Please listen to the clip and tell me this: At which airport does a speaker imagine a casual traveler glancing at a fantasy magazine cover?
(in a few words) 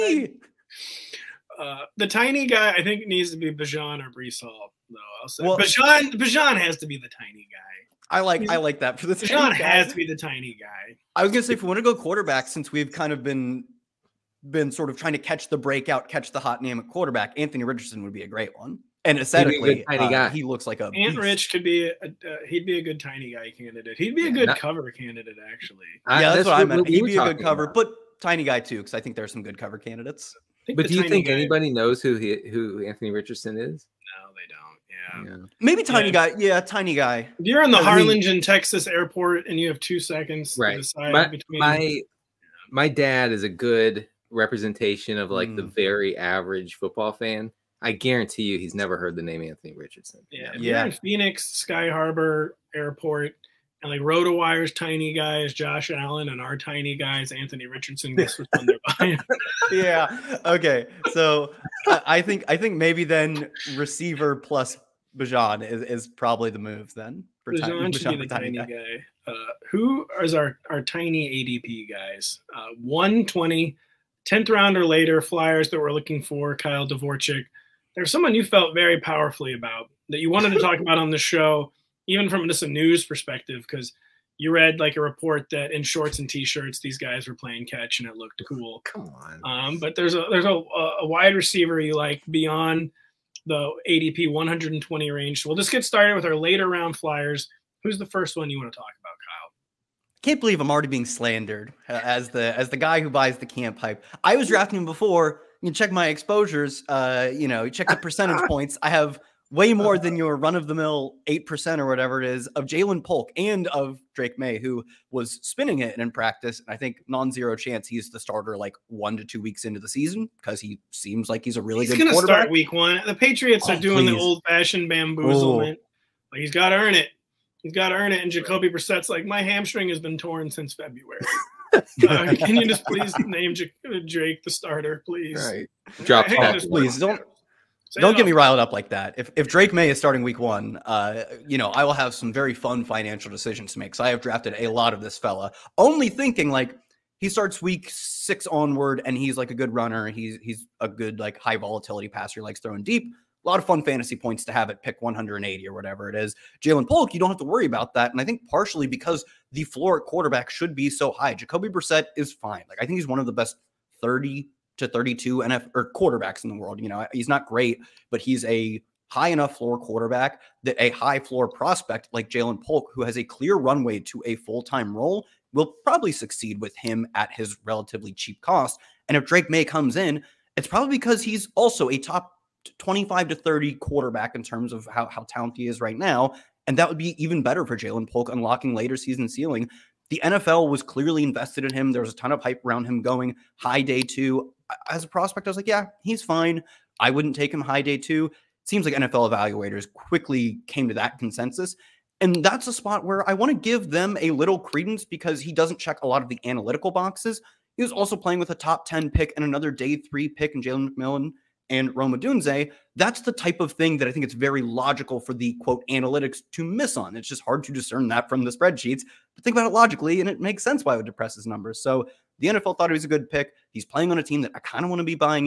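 Phoenix Sky Harbor Airport.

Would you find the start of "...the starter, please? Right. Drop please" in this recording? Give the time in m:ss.
2:14.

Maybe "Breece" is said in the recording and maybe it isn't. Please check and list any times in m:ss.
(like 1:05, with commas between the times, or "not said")
0:04.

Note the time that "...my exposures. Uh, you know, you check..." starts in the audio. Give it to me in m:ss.
1:45.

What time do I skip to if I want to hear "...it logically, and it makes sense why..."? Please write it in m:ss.
3:39.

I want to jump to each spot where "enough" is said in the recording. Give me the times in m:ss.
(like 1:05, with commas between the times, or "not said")
2:49.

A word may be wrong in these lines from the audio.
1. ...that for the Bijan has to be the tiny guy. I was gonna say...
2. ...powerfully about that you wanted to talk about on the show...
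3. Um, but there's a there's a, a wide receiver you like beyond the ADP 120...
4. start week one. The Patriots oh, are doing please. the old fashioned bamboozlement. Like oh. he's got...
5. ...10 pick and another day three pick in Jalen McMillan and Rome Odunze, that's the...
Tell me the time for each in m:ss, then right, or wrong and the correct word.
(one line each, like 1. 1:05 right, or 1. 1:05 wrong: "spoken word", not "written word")
1. 0:08 right
2. 1:18 right
3. 1:29 right
4. 2:02 right
5. 3:28 right.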